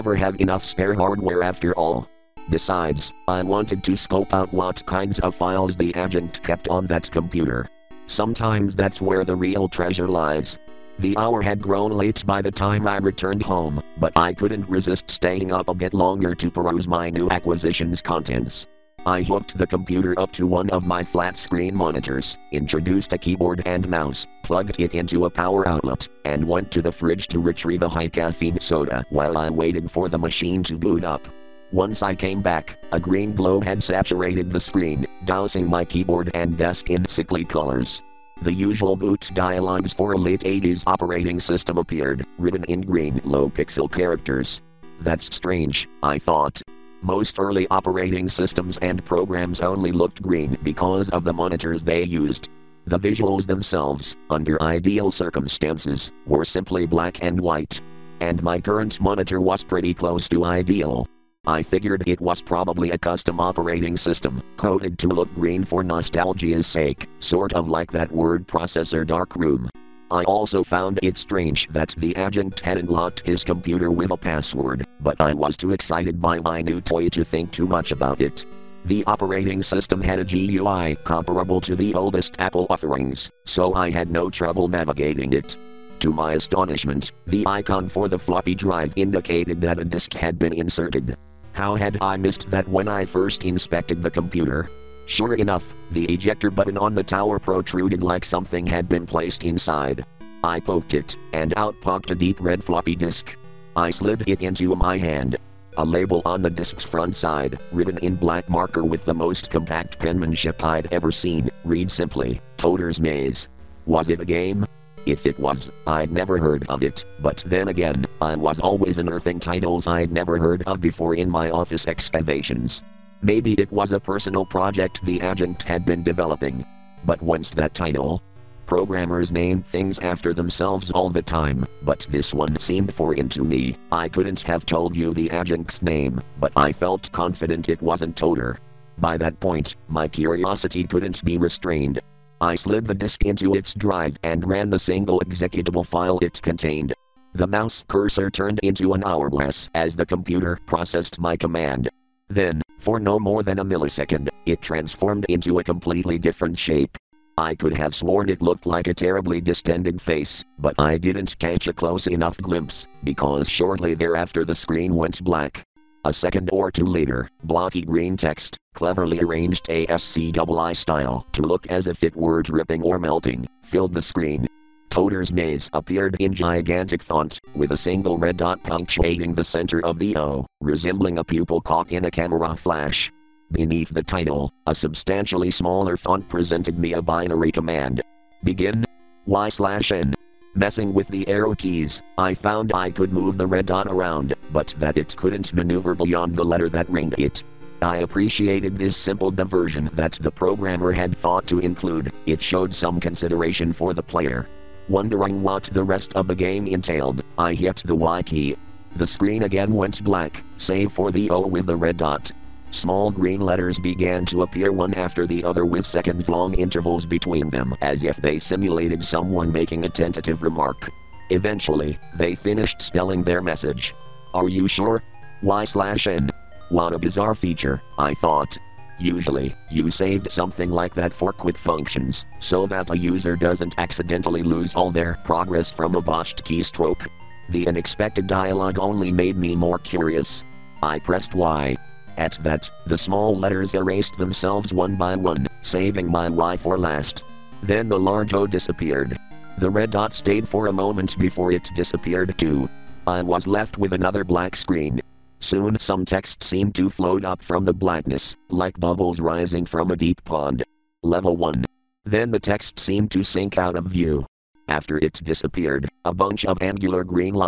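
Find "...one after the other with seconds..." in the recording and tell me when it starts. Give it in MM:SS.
03:34.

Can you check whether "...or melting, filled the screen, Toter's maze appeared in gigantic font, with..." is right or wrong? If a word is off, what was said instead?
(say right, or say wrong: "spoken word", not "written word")
right.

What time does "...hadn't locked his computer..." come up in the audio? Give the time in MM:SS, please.
01:12.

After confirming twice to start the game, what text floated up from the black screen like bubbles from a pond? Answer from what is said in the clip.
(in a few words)
Level 1.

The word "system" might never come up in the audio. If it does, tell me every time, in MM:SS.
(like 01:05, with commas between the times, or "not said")
00:41, 00:48, 01:03, 01:19.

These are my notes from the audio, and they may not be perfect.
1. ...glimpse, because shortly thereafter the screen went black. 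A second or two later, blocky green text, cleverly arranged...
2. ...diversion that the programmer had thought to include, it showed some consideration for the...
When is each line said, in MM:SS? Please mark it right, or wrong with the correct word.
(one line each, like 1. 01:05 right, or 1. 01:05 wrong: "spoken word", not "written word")
1. 02:42 right
2. 03:19 right.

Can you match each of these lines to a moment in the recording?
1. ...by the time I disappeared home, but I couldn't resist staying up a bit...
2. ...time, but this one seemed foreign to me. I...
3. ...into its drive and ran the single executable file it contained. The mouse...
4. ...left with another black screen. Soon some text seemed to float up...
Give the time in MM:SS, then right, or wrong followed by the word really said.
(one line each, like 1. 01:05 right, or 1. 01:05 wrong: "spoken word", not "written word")
1. 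00:12 wrong: "returned", not "disappeared"
2. 02:11 right
3. 02:23 right
4. 04:13 right.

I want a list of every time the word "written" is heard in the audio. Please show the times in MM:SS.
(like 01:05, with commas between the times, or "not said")
00:42, 01:47.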